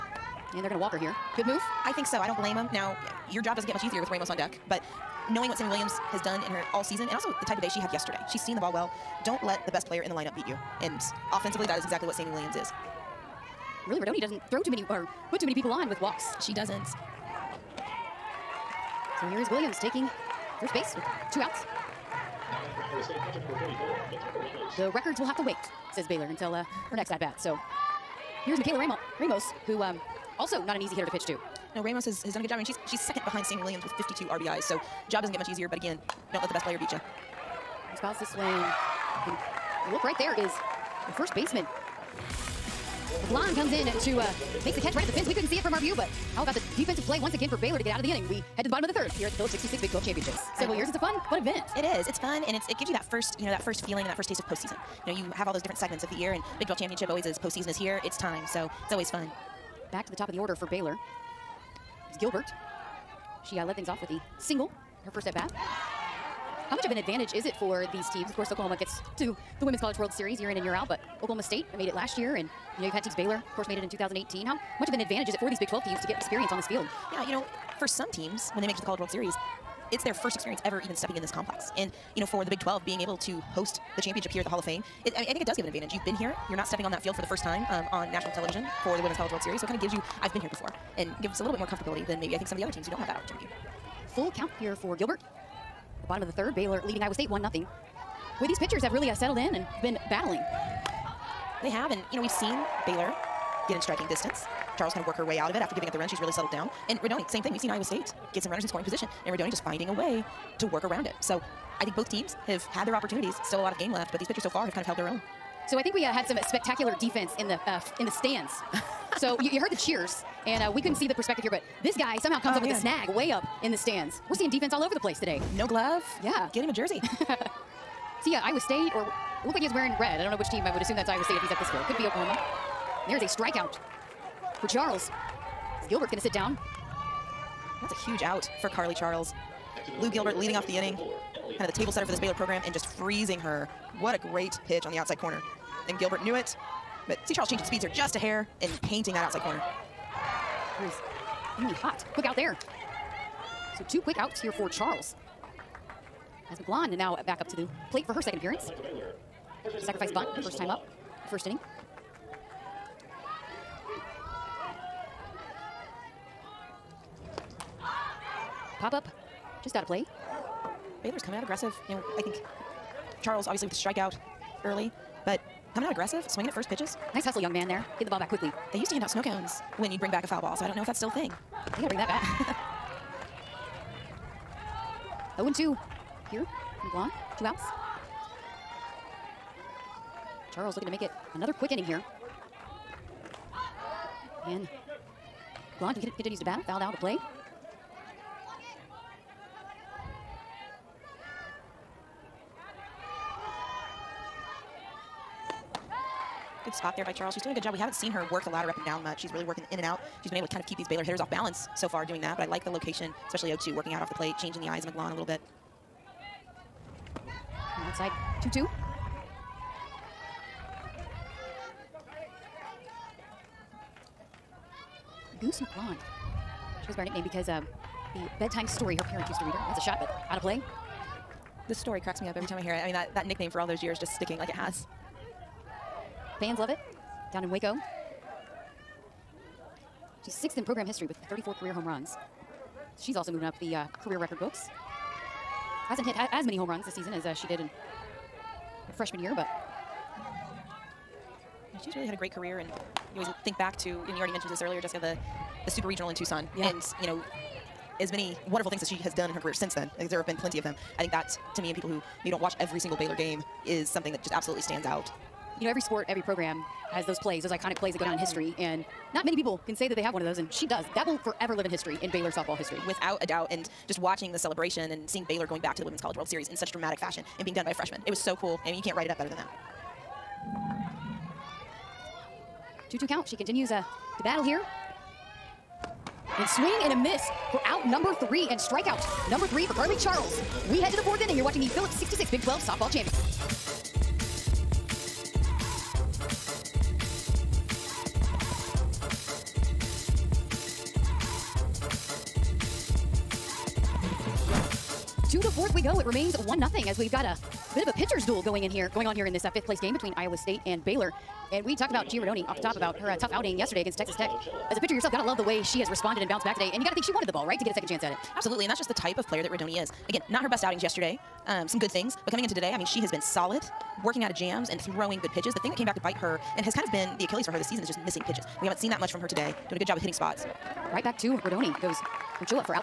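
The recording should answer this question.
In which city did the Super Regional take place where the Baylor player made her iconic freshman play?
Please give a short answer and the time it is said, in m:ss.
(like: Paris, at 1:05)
Tucson, at 4:16.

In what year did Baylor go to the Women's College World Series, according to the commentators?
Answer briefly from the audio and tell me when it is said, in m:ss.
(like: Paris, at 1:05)
2018, at 1:13.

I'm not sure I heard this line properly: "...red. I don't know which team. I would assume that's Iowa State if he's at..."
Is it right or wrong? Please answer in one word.
right.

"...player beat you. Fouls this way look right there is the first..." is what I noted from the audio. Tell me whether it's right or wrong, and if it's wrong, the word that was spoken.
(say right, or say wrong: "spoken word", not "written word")
right.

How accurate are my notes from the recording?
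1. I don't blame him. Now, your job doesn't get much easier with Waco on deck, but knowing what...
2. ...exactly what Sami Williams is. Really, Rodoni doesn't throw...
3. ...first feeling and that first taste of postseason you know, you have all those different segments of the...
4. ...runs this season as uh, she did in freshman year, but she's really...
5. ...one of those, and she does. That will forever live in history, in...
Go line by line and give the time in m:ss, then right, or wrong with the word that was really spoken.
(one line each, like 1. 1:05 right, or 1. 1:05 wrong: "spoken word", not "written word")
1. 0:02 wrong: "Ramos", not "Waco"
2. 0:11 right
3. 0:53 right
4. 4:06 right
5. 4:30 right.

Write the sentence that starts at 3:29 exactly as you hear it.
She's really working in and out.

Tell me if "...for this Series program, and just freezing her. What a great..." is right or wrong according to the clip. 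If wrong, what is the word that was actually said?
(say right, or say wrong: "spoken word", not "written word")
wrong: "Baylor", not "Series".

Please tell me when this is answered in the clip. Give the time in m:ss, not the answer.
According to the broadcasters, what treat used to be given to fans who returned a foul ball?
2:59.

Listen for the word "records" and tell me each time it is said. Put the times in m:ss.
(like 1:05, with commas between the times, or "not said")
0:24, 4:04.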